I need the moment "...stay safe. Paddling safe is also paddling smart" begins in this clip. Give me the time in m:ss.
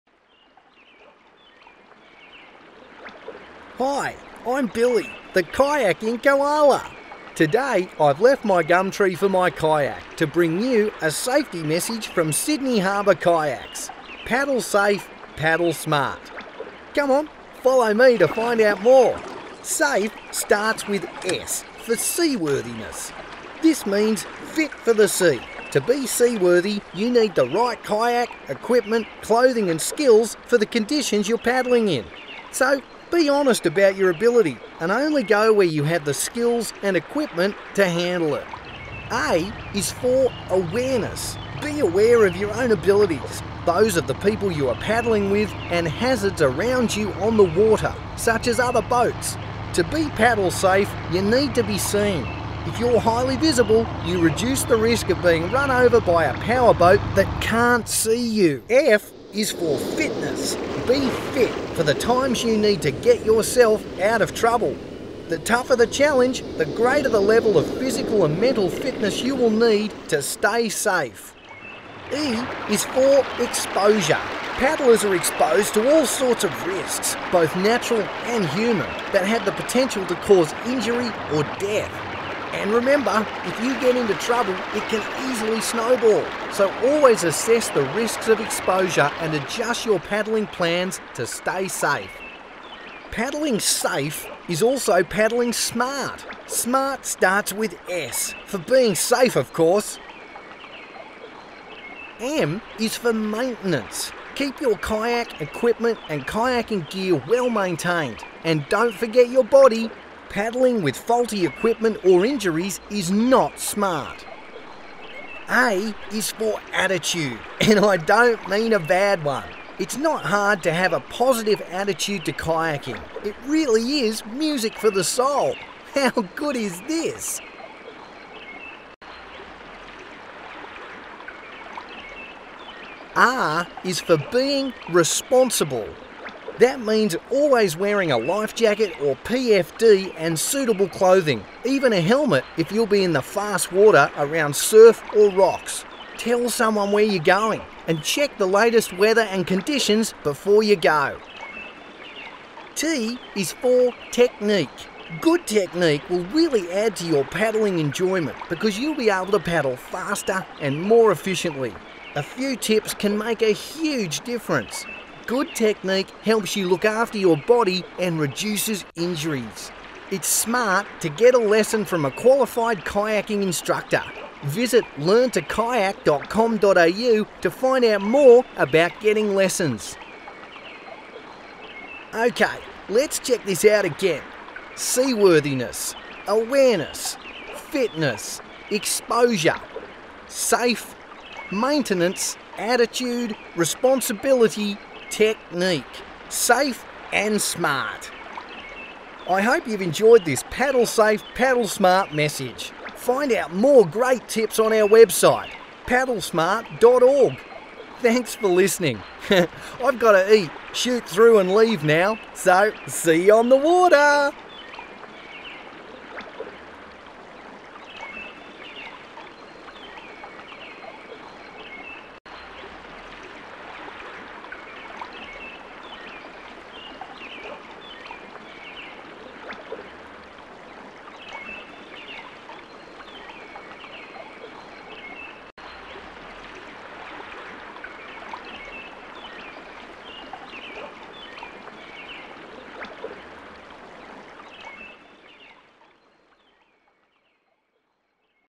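1:31.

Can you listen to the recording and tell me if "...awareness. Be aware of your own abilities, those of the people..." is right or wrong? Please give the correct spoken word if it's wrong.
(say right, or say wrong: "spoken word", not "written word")
right.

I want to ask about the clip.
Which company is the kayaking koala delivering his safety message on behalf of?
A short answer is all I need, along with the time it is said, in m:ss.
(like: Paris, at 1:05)
Sydney Harbour Kayaks, at 0:12.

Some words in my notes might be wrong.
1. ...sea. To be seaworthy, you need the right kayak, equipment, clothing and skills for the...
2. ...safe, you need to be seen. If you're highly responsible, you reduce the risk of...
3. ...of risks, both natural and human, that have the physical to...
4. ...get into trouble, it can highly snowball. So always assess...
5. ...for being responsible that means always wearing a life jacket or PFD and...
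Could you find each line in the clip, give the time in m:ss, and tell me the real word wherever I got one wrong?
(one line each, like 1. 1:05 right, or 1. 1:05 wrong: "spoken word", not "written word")
1. 0:25 right
2. 0:50 wrong: "visible", not "responsible"
3. 1:16 wrong: "potential", not "physical"
4. 1:23 wrong: "easily", not "highly"
5. 2:13 right.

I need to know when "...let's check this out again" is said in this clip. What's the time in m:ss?
3:02.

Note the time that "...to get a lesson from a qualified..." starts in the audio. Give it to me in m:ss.
2:50.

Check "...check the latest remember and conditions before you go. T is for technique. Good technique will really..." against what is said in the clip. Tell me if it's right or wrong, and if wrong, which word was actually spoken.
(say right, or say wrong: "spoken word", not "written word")
wrong: "weather", not "remember".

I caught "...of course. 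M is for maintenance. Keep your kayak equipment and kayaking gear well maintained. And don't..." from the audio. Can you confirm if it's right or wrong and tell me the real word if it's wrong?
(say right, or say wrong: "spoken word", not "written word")
right.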